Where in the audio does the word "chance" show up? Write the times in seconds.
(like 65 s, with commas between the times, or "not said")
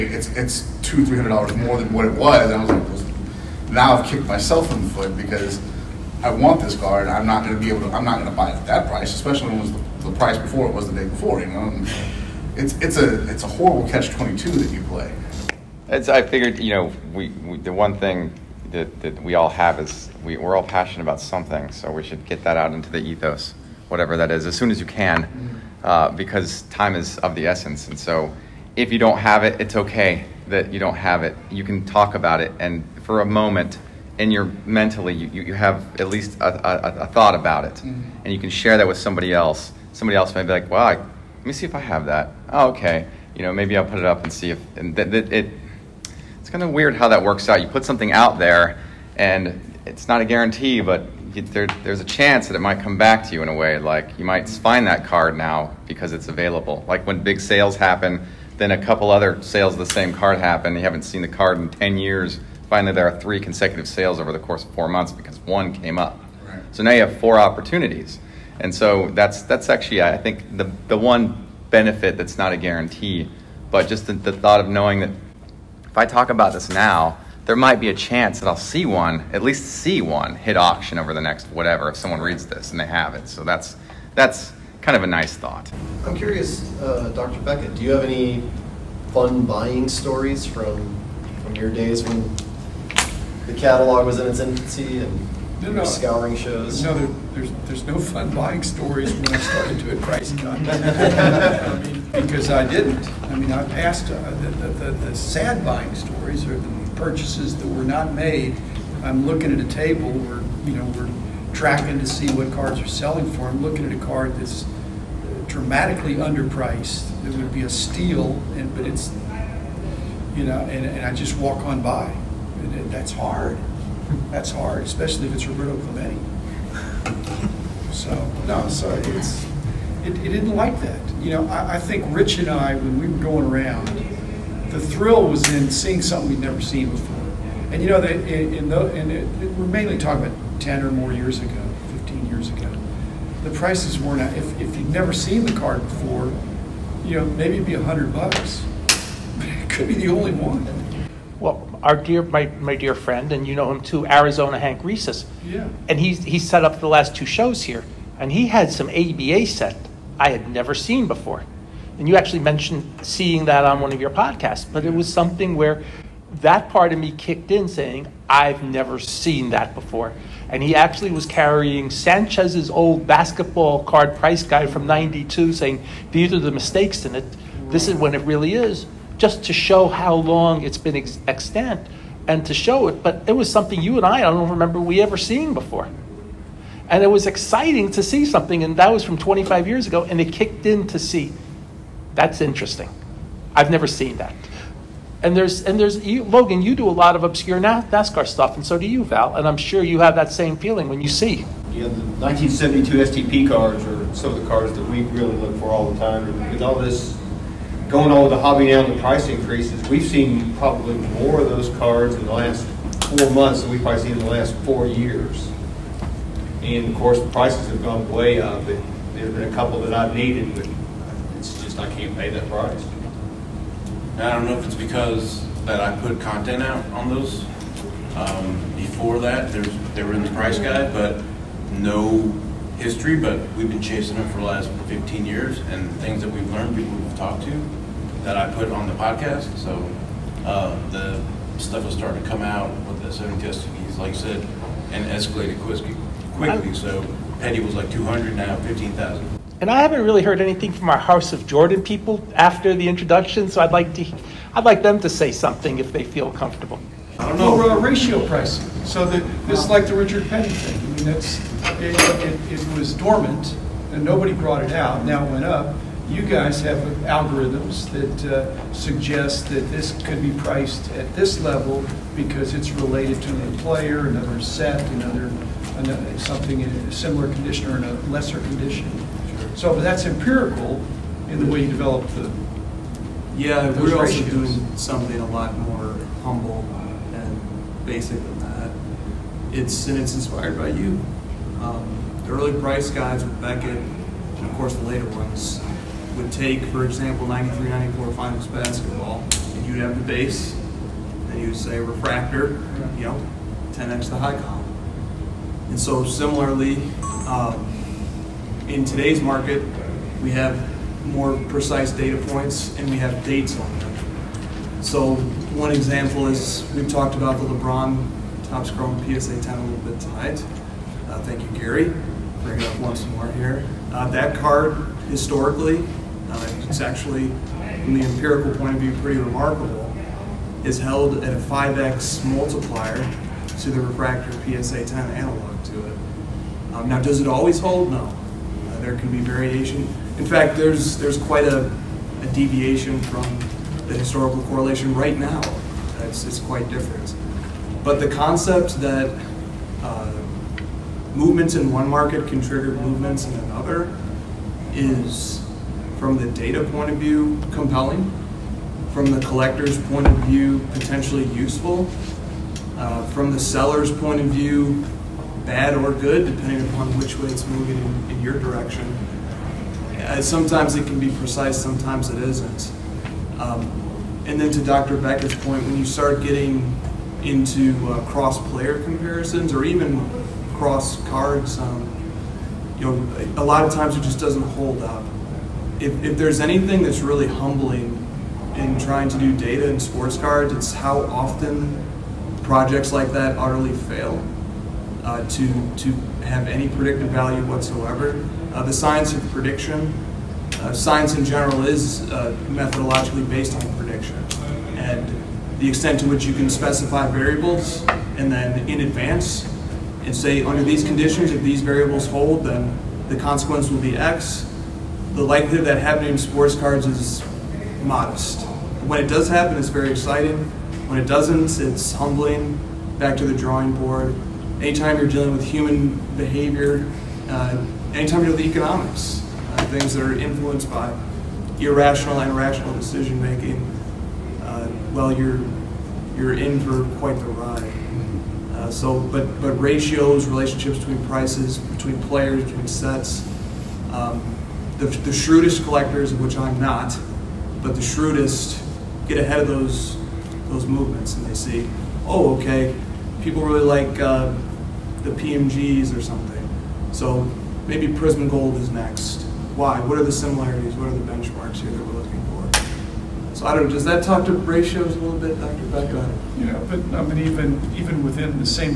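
52 s, 77 s.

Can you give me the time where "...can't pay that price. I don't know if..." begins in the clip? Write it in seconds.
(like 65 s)
221 s.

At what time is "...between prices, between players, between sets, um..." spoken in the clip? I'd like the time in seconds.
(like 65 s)
440 s.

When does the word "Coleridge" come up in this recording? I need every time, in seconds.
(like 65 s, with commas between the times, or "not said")
not said.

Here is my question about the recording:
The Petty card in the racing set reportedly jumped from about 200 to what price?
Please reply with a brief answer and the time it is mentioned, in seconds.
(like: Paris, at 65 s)
15,000, at 248 s.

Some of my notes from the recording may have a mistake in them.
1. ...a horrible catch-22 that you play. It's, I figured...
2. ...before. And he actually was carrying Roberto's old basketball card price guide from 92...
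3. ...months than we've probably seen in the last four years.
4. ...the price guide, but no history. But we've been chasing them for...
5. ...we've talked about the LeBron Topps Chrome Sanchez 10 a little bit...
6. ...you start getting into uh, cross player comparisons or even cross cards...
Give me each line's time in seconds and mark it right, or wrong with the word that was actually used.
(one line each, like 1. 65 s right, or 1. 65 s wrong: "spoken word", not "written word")
1. 13 s right
2. 169 s wrong: "Sanchez", not "Roberto"
3. 213 s right
4. 230 s right
5. 316 s wrong: "PSA", not "Sanchez"
6. 375 s right.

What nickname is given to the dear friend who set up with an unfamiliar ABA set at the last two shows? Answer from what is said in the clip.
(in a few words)
Arizona Hank Reeses.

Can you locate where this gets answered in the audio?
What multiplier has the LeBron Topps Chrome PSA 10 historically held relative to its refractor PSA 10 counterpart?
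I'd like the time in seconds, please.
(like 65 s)
331 s.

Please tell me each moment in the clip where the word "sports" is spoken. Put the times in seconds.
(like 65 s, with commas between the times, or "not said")
389 s, 416 s.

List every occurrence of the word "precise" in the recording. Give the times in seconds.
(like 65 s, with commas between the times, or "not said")
311 s, 371 s.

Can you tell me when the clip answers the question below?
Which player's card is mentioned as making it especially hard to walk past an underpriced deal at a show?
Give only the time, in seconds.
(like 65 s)
125 s.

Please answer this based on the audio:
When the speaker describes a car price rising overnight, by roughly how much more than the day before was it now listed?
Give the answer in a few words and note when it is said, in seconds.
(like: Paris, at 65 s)
$200-300, at 0 s.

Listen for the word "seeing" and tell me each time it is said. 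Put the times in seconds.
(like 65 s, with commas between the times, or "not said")
135 s, 163 s, 185 s.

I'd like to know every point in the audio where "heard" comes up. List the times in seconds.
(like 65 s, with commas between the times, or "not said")
250 s.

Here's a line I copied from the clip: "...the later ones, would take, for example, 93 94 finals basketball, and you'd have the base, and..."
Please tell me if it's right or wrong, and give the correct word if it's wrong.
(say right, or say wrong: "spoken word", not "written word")
right.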